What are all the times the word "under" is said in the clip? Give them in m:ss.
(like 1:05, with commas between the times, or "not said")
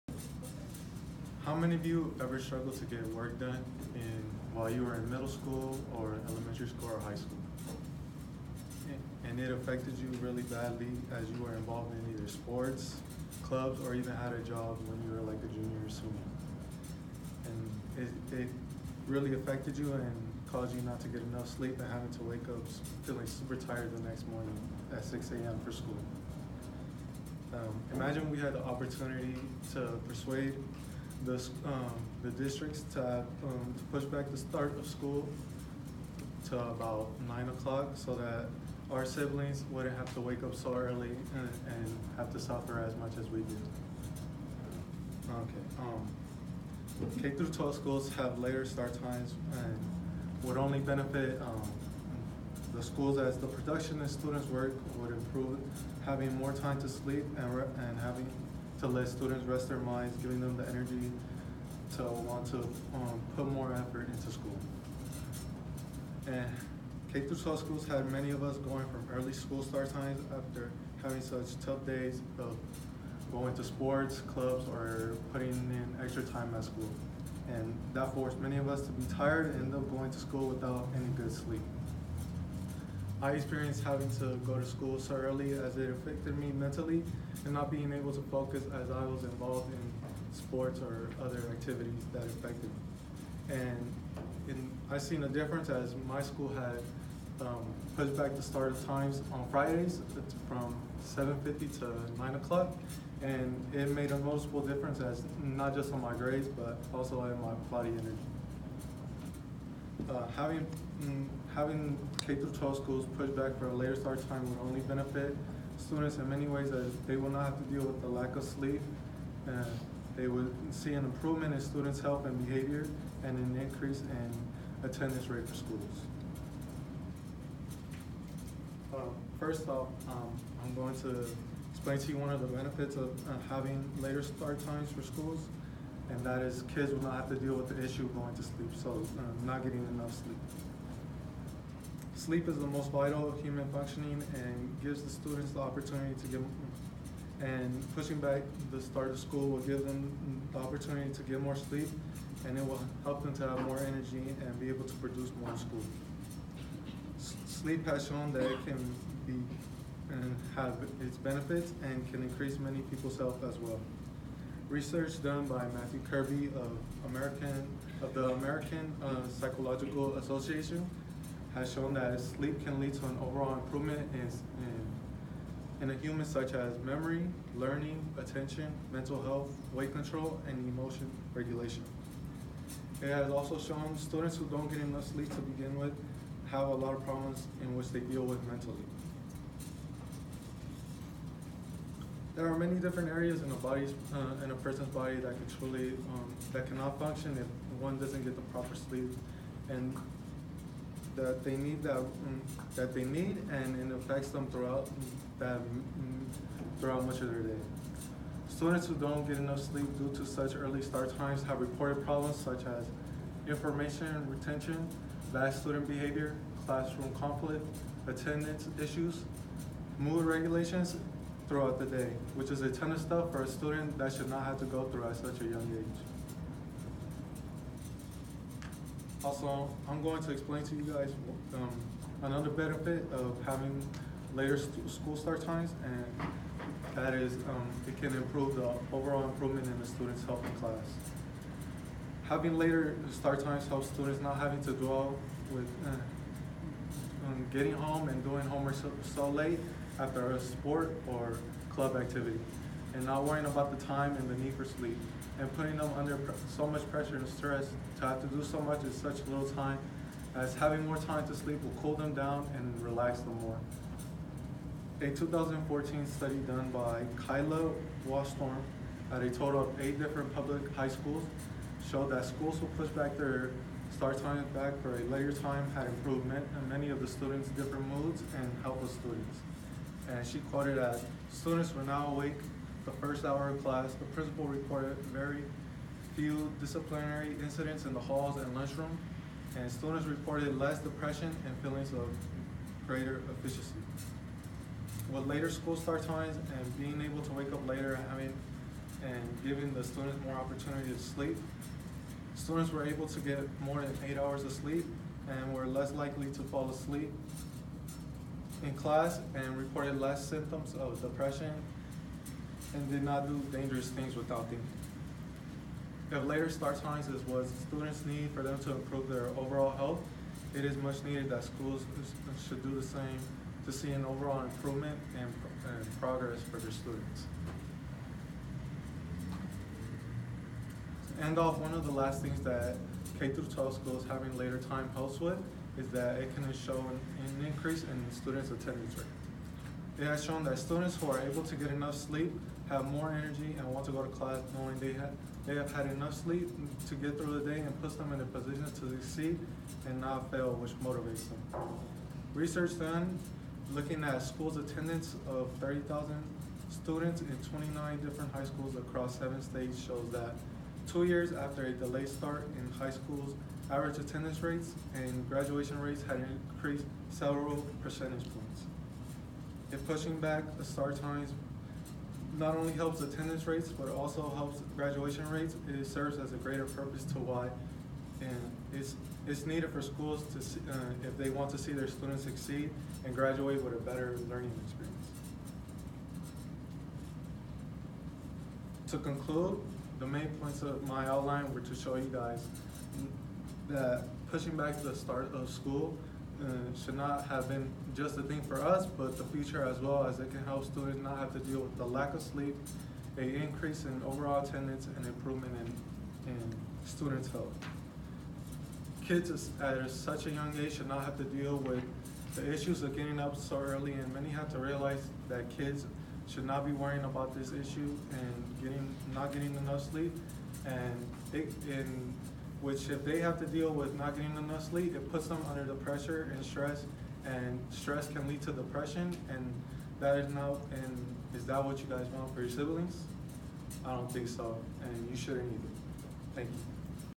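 4:15, 7:05.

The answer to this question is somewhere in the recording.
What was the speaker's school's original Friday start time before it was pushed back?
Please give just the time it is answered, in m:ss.
1:41.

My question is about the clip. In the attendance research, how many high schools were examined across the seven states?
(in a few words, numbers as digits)
29.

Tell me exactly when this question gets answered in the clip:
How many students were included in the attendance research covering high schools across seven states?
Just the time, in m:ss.
5:55.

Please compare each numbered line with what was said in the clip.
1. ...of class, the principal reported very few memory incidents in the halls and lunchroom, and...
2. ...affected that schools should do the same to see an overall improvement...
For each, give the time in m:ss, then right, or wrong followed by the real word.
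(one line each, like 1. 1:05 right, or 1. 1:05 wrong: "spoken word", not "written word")
1. 4:43 wrong: "disciplinary", not "memory"
2. 5:21 wrong: "needed", not "affected".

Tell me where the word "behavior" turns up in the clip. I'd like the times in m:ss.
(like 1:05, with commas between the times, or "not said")
2:02, 3:35.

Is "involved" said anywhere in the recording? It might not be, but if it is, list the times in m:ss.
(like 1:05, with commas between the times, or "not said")
0:11, 1:29.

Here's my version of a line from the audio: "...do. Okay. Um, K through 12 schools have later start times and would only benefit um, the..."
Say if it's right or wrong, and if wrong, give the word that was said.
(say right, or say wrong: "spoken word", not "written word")
right.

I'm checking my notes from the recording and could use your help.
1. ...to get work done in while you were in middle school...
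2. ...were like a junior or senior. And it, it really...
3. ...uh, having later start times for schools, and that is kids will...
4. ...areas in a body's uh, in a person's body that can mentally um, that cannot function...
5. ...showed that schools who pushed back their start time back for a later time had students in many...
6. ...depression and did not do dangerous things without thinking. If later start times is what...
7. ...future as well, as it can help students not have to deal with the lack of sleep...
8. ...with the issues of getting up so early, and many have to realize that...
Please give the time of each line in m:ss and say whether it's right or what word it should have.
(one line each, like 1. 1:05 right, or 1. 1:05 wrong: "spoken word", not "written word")
1. 0:02 right
2. 0:15 right
3. 2:13 right
4. 3:13 wrong: "truly", not "mentally"
5. 4:31 wrong: "improvement", not "students"
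6. 5:11 right
7. 6:39 right
8. 6:51 right.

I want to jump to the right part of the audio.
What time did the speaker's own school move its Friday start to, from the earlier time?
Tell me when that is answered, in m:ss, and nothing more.
1:42.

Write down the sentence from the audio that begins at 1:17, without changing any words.
And that forced many of us to be tired and end up going to school without any good sleep.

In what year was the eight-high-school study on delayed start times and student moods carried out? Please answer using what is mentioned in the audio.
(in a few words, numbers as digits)
2014.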